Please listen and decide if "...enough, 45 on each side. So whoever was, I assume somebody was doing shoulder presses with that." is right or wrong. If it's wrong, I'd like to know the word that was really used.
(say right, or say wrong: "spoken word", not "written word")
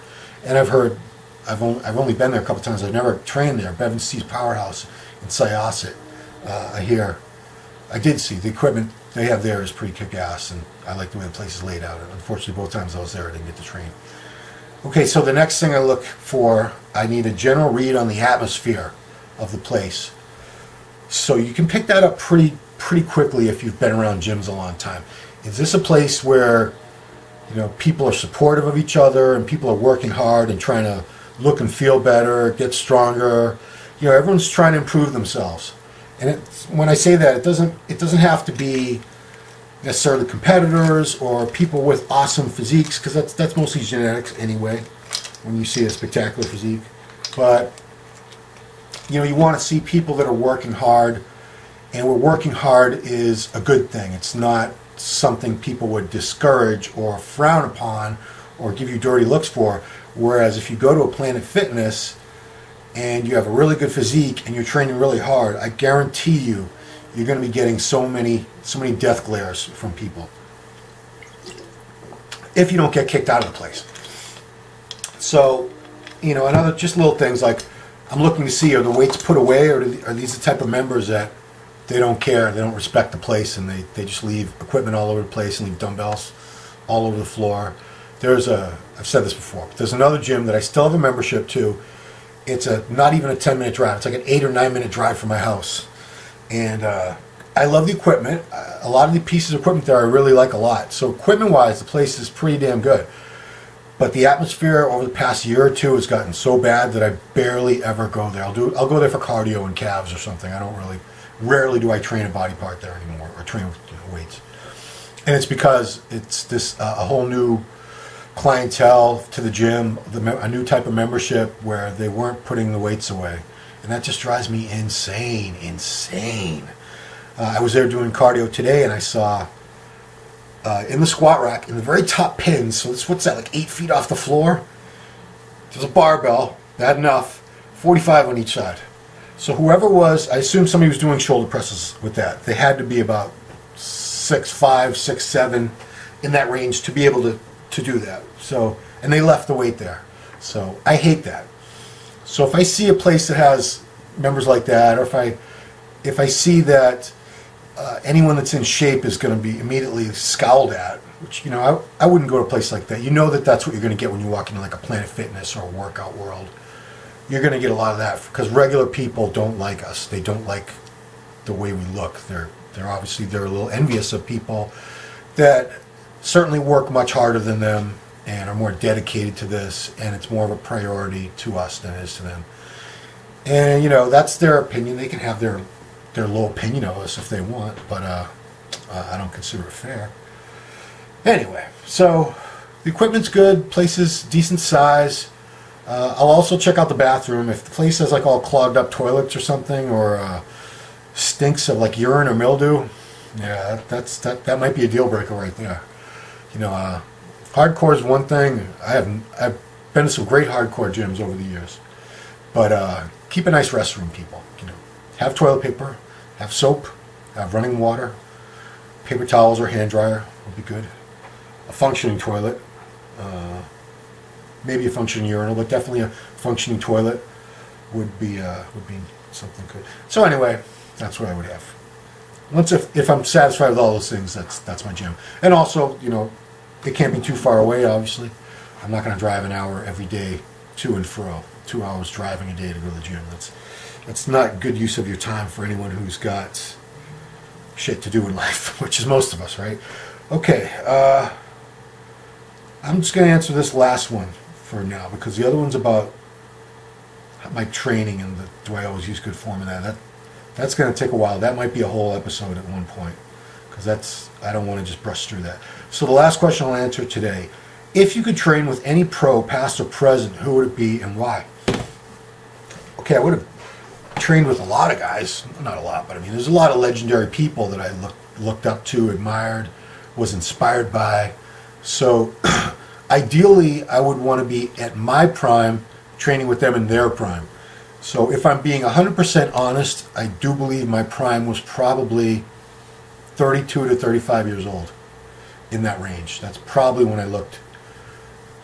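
right.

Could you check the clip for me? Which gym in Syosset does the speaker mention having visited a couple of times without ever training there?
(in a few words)
Bev Francis' Powerhouse.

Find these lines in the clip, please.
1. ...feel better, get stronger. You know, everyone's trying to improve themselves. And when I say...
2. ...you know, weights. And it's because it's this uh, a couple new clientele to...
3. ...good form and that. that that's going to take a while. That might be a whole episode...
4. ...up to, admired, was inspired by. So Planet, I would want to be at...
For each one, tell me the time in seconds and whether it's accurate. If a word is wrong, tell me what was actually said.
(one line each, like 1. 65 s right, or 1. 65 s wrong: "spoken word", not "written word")
1. 31 s right
2. 113 s wrong: "whole", not "couple"
3. 259 s right
4. 278 s wrong: "Ideally", not "Planet".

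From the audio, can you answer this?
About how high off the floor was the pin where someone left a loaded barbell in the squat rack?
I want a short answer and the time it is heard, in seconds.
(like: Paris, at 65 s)
8 feet, at 133 s.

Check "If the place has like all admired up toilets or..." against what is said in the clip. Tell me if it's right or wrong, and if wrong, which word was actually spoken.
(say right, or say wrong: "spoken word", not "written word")
wrong: "clogged", not "admired".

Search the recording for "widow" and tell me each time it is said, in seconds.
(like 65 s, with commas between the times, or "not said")
not said.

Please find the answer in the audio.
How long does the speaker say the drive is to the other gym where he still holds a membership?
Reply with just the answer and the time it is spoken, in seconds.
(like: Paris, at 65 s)
8 or 9 minutes, at 94 s.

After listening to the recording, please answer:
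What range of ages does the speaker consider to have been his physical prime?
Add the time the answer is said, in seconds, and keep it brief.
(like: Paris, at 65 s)
32 to 35, at 293 s.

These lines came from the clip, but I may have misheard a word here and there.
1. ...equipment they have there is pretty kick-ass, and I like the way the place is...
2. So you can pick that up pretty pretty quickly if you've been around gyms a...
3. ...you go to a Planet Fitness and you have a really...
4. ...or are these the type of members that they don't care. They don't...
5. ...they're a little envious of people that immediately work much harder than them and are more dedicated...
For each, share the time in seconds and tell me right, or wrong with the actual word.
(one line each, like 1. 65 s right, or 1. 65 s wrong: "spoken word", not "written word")
1. 8 s right
2. 21 s right
3. 60 s right
4. 79 s right
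5. 173 s wrong: "certainly", not "immediately".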